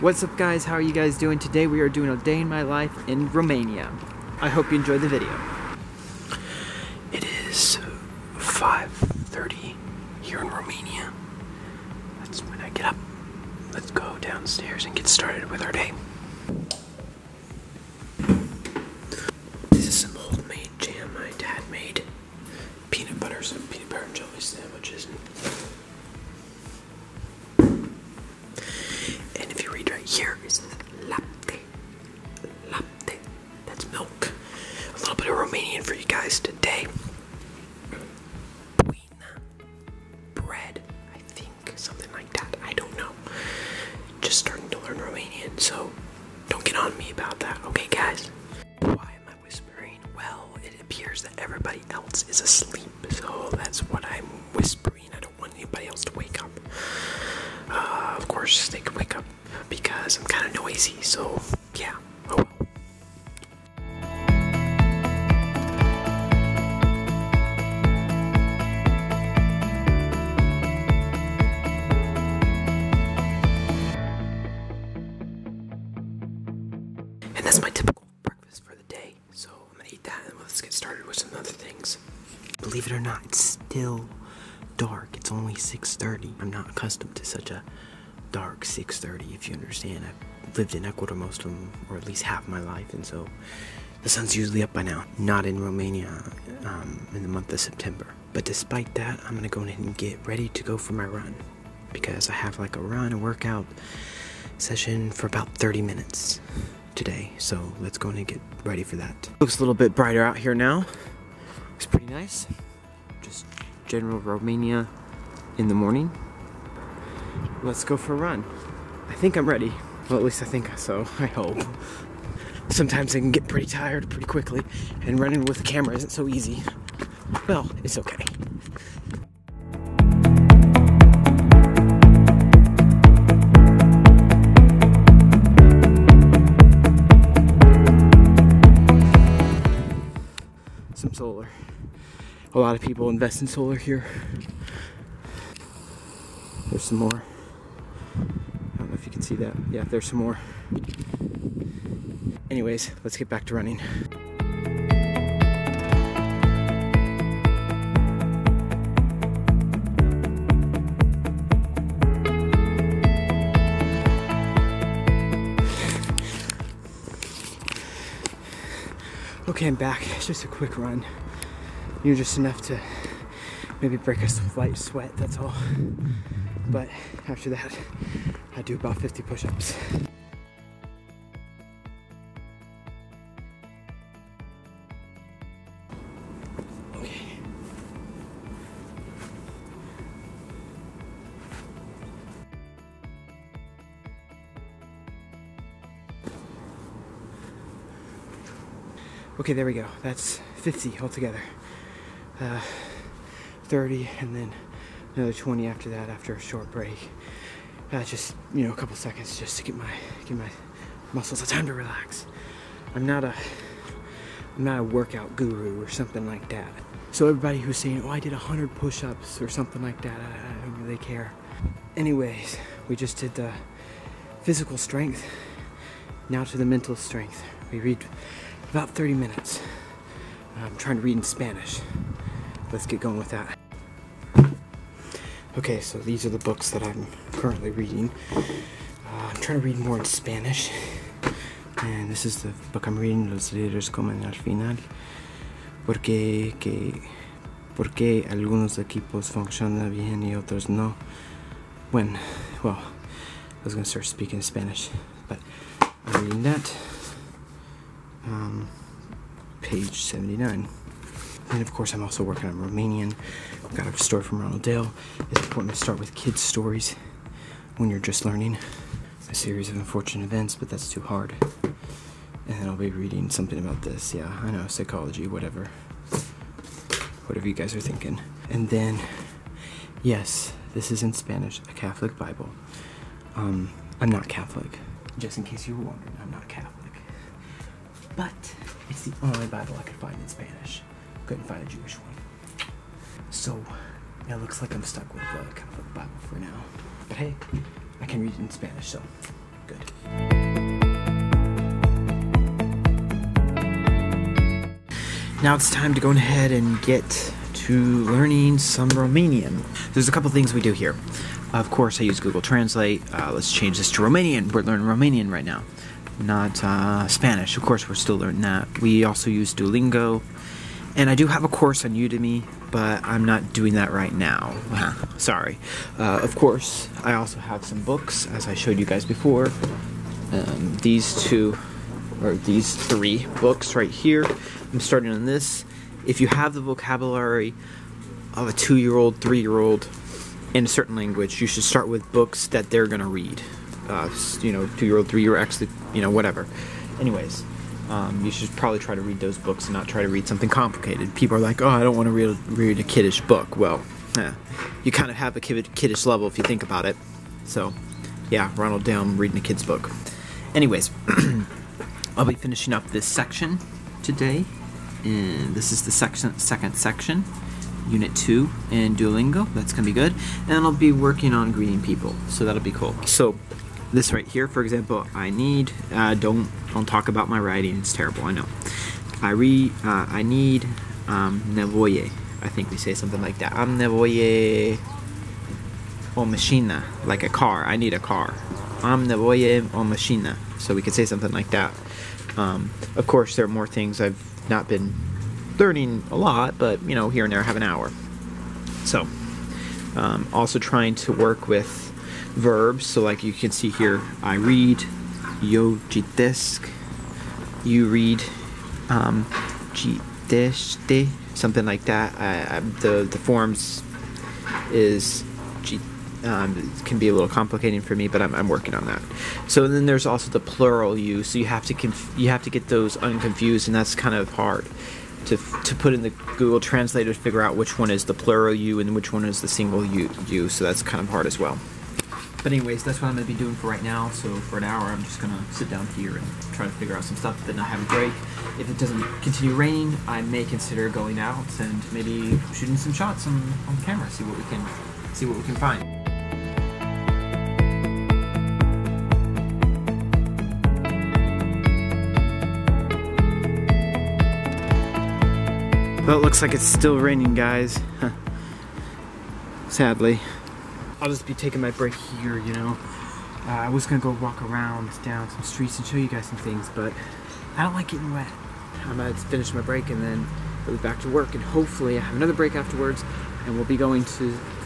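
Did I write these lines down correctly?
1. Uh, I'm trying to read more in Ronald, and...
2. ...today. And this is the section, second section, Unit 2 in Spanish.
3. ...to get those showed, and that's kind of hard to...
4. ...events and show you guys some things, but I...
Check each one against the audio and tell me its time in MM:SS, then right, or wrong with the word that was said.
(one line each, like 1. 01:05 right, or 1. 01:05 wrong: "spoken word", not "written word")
1. 03:58 wrong: "Spanish", not "Ronald"
2. 06:04 wrong: "Duolingo", not "Spanish"
3. 07:02 wrong: "unconfused", not "showed"
4. 07:45 wrong: "streets", not "events".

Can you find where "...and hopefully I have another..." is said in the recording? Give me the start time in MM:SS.
07:51.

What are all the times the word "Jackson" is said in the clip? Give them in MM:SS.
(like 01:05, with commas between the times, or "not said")
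not said.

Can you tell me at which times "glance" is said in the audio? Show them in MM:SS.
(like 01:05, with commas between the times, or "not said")
not said.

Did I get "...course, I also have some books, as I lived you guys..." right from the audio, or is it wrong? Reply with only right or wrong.
wrong.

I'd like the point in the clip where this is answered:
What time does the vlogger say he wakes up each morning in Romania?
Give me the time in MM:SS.
00:08.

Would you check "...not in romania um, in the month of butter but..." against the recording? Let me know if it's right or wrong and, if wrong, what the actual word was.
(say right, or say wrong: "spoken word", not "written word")
wrong: "september", not "butter".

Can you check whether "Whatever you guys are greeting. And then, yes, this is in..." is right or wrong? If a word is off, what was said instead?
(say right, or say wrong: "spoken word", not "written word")
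wrong: "thinking", not "greeting".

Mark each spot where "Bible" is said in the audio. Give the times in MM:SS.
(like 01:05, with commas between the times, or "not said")
04:42, 04:49, 04:55.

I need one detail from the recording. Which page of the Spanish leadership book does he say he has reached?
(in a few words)
79.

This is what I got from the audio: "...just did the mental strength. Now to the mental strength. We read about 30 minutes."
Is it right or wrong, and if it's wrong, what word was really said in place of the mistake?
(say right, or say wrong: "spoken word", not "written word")
wrong: "physical", not "mental".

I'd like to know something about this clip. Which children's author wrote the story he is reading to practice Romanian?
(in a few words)
Roald Dahl.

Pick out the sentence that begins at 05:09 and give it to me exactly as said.
There's a couple things we do here.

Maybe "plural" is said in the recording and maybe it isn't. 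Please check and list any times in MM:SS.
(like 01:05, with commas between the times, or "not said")
07:00, 07:08.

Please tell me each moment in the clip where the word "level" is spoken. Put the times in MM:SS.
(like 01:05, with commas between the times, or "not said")
05:56.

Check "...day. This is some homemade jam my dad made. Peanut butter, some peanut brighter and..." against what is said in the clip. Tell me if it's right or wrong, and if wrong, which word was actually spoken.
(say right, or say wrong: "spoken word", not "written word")
wrong: "butter", not "brighter".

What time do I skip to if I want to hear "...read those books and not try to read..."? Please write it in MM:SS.
05:49.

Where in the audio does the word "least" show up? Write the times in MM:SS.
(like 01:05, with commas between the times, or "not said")
01:32, 02:00.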